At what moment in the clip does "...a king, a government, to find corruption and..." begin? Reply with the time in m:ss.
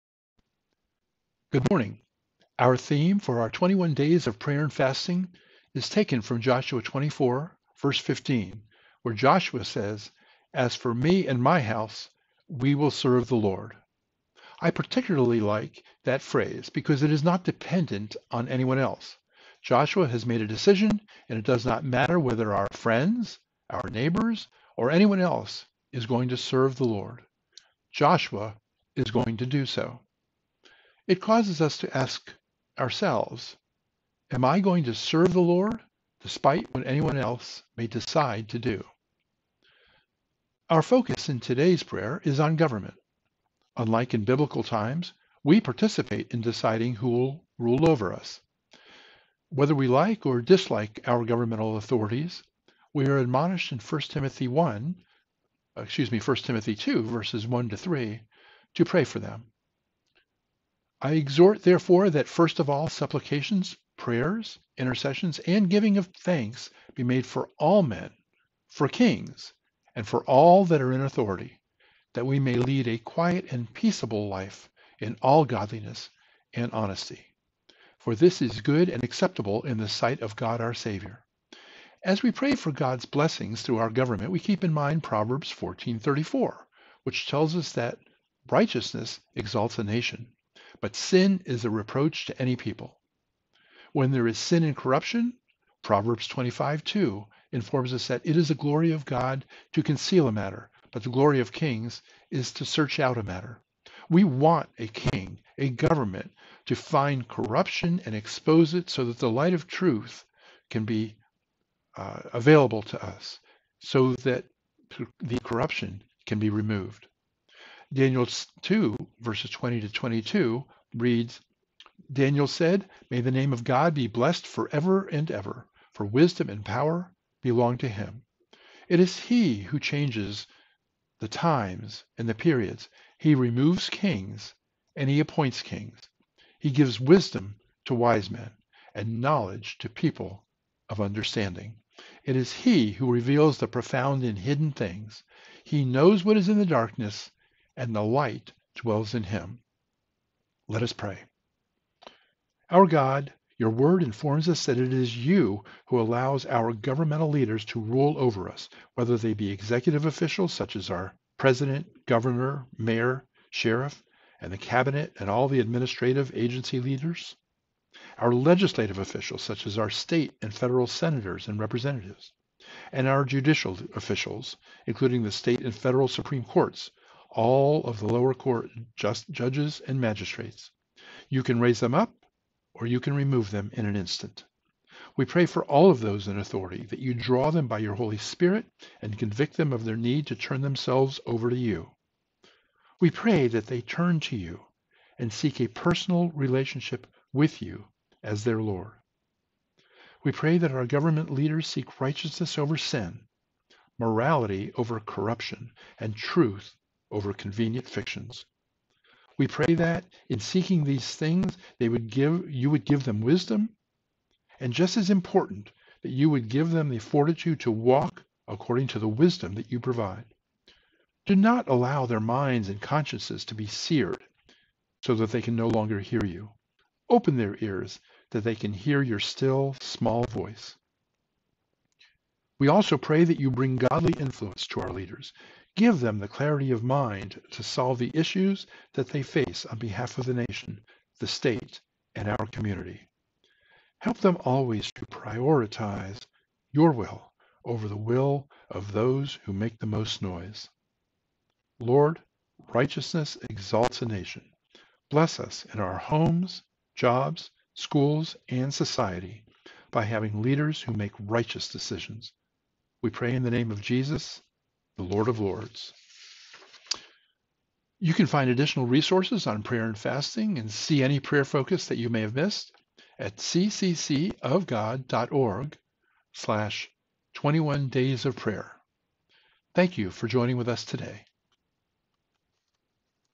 1:44.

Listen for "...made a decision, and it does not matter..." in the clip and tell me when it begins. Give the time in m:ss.
0:20.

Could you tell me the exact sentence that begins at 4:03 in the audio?
Help them always to prioritize your will over the will of those who make the most noise.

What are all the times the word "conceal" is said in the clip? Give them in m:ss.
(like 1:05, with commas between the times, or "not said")
1:39.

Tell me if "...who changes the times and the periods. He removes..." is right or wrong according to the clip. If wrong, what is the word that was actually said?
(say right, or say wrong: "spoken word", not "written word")
right.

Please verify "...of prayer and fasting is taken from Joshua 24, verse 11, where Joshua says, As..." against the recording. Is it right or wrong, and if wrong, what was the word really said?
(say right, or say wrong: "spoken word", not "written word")
wrong: "15", not "11".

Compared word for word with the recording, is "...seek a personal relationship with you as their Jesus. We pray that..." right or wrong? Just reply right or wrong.
wrong.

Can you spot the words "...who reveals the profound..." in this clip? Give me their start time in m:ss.
2:22.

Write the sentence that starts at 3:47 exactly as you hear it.
Open their ears that they can hear your still, small voice.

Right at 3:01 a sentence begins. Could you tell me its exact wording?
You can raise them up or you can remove them in an instant.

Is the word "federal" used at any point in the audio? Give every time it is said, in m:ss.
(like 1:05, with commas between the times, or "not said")
2:50, 2:55.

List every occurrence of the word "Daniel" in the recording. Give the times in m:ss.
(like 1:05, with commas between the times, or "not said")
1:57, 2:02.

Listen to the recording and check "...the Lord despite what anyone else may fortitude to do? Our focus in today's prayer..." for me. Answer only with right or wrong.
wrong.